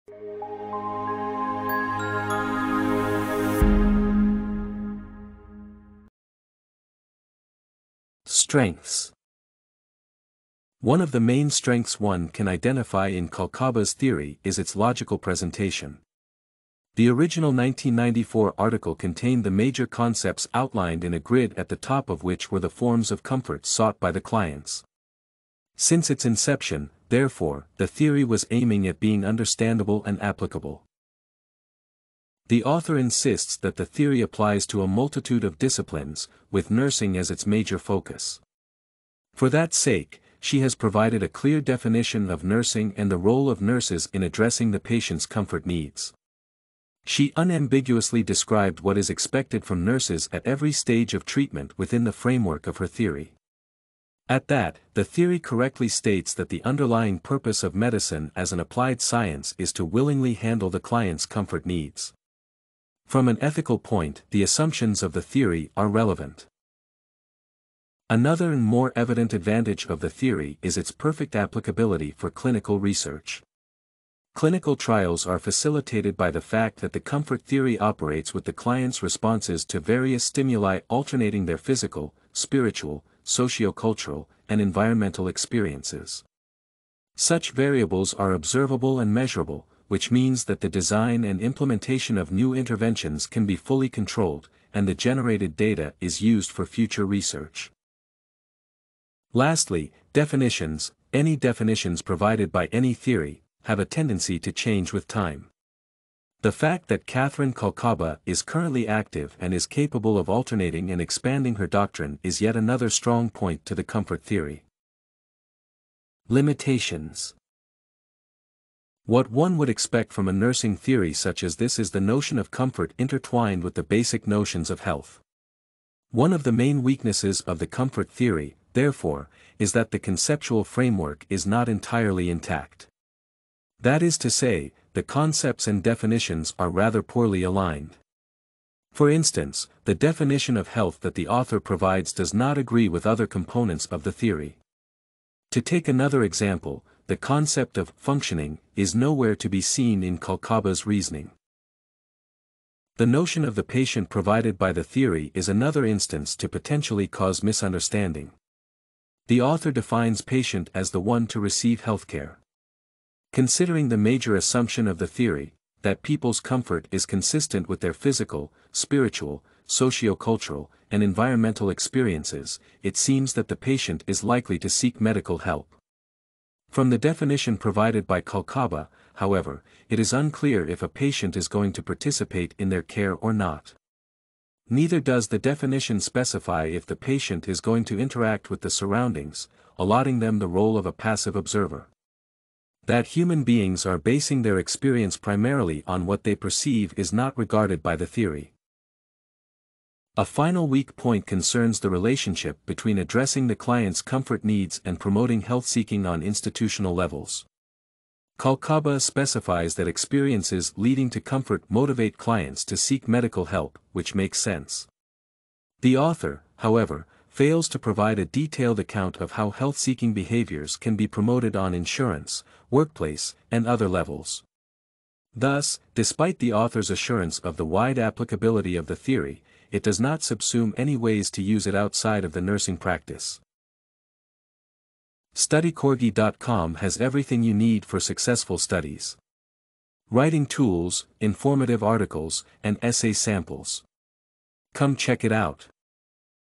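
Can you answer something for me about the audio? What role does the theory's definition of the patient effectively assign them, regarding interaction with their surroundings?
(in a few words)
Passive observer.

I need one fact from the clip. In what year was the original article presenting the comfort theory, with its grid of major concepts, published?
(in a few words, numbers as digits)
1994.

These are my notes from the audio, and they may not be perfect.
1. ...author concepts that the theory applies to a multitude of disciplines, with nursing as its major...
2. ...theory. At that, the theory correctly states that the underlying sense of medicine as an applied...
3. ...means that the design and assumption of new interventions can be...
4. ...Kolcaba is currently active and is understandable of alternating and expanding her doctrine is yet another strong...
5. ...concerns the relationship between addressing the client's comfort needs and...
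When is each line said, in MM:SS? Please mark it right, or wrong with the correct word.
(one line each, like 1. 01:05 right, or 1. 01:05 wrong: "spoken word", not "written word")
1. 00:32 wrong: "insists", not "concepts"
2. 00:52 wrong: "purpose", not "sense"
3. 01:30 wrong: "implementation", not "assumption"
4. 01:47 wrong: "capable", not "understandable"
5. 03:21 right.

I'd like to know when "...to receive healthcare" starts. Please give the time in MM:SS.
02:41.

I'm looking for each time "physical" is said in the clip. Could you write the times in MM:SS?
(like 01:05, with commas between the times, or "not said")
01:21, 02:47.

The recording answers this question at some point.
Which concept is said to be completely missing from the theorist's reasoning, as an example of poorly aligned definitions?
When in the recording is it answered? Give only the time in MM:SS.
02:27.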